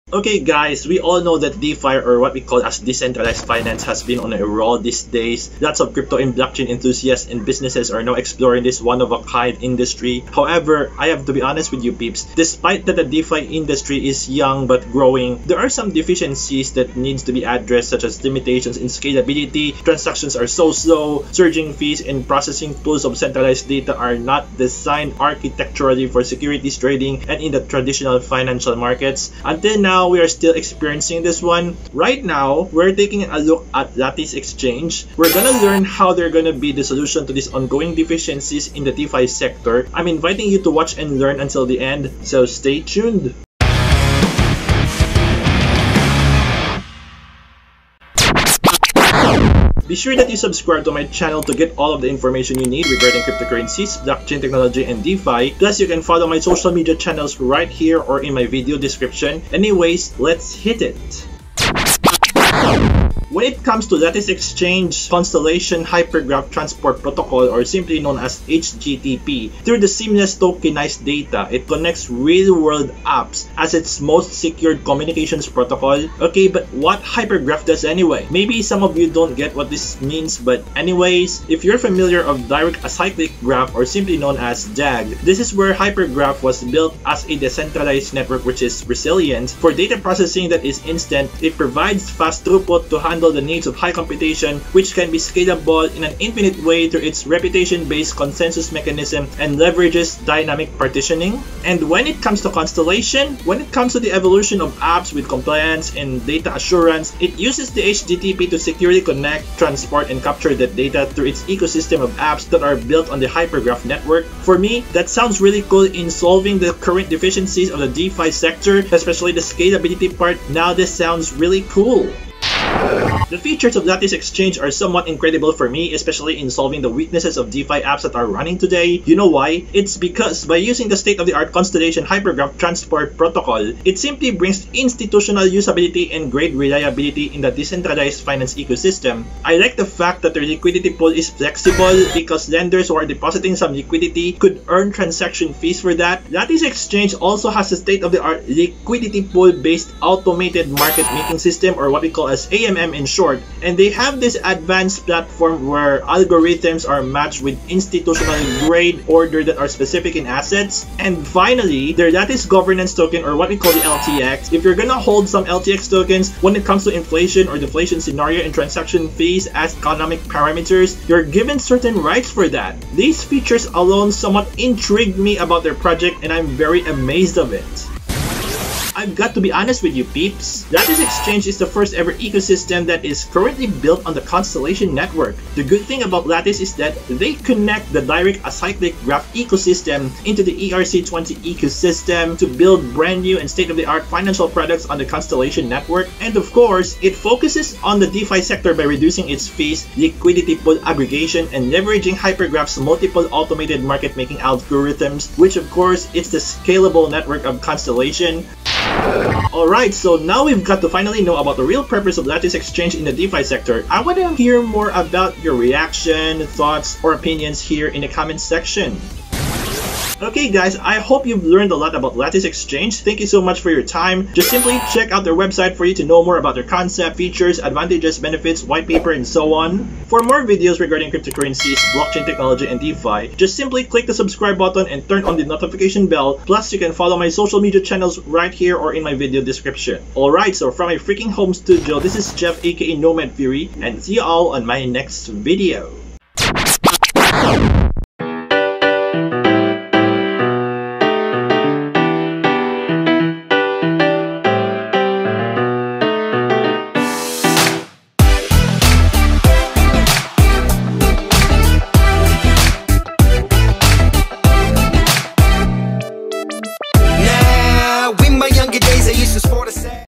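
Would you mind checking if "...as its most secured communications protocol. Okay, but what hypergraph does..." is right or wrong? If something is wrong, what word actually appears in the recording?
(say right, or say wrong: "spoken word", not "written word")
right.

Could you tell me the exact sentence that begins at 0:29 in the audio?
Until now, now we are still experiencing this one.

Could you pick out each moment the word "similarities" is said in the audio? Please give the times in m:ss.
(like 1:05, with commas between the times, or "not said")
not said.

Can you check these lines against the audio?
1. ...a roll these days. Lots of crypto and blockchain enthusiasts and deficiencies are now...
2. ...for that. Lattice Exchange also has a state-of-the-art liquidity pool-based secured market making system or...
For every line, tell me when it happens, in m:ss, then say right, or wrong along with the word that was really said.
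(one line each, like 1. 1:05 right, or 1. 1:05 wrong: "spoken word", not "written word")
1. 0:04 wrong: "businesses", not "deficiencies"
2. 2:25 wrong: "automated", not "secured".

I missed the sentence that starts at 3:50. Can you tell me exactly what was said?
For more videos regarding cryptocurrencies, blockchain technology, and DeFi, just simply click the subscribe button and turn on the notification bell.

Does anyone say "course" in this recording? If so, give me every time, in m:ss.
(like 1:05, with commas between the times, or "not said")
3:16, 3:25.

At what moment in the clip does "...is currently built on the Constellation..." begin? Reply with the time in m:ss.
3:03.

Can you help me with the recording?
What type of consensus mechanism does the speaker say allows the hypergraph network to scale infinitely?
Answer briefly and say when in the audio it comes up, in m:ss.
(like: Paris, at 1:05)
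reputation-based, at 1:37.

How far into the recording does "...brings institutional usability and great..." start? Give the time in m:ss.
2:14.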